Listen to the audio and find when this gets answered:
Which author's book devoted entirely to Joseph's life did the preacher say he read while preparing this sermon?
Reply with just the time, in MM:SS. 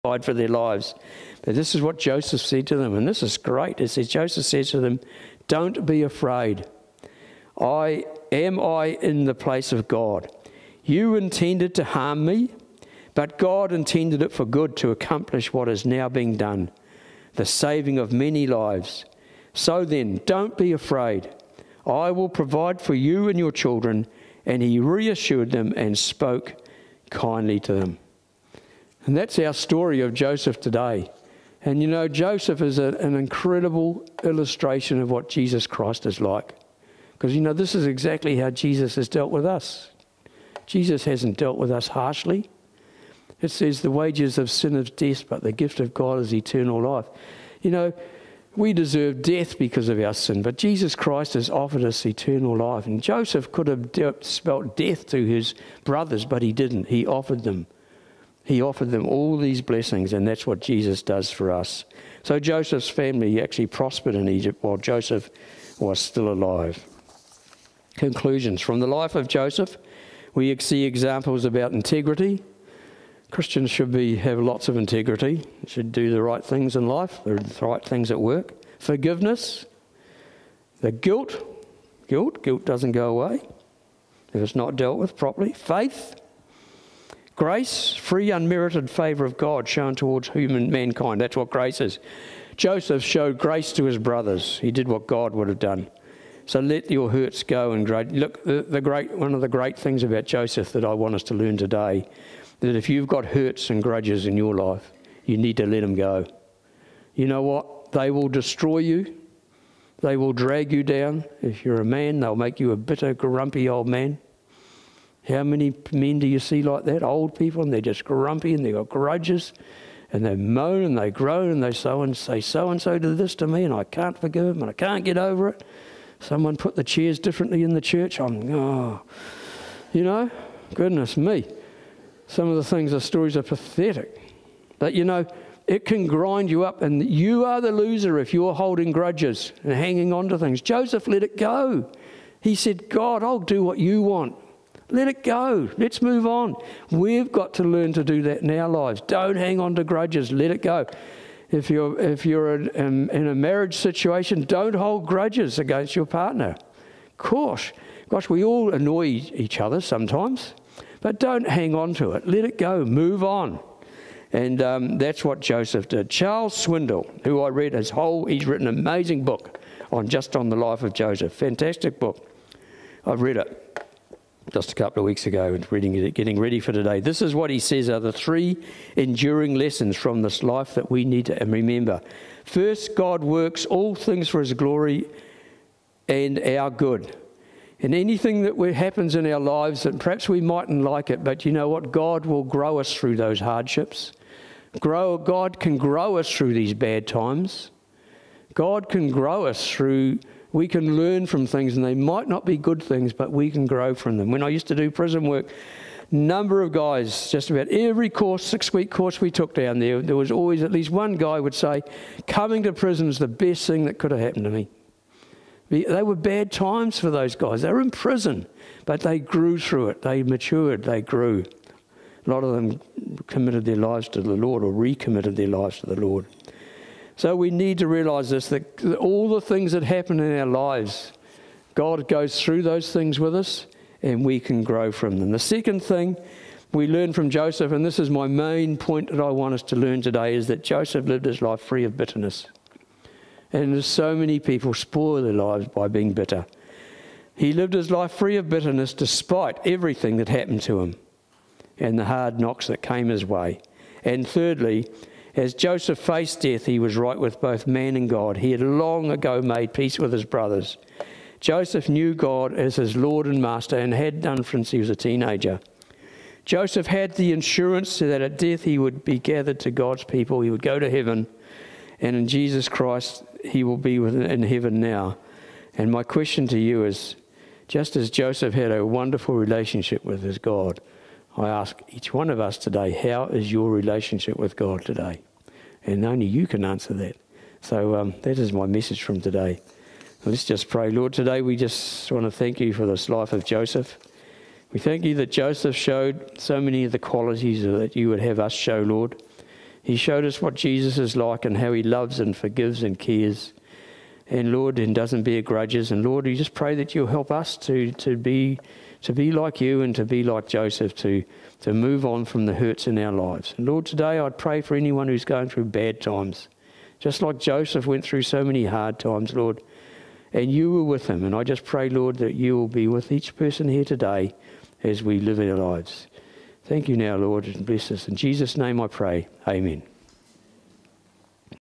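02:46.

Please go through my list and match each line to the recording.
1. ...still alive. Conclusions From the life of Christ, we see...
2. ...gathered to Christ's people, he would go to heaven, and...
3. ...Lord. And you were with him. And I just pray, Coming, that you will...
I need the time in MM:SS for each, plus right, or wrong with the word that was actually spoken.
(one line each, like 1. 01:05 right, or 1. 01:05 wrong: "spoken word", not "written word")
1. 01:05 wrong: "Joseph", not "Christ"
2. 04:29 wrong: "God", not "Christ"
3. 05:19 wrong: "Lord", not "Coming".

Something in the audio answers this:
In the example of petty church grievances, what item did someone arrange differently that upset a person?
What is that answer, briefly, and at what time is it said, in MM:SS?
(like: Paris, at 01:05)
The chairs, at 02:06.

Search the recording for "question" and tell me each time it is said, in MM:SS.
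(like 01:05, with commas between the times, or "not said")
04:36.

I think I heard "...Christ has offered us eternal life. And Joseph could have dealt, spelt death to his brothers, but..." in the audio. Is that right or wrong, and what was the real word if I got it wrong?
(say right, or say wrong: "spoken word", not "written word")
right.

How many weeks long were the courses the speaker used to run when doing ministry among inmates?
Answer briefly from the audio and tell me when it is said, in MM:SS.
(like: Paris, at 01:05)
6, at 03:28.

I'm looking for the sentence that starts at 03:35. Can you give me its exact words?
They were bad times for those guys.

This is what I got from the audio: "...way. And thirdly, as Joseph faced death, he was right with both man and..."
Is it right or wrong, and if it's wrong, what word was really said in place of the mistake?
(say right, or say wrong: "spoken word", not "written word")
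right.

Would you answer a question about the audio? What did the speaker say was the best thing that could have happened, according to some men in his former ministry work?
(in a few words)
Coming to prison.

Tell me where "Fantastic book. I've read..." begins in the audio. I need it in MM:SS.
02:51.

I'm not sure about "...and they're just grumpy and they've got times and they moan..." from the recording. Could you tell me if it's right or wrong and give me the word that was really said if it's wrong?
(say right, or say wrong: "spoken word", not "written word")
wrong: "grudges", not "times".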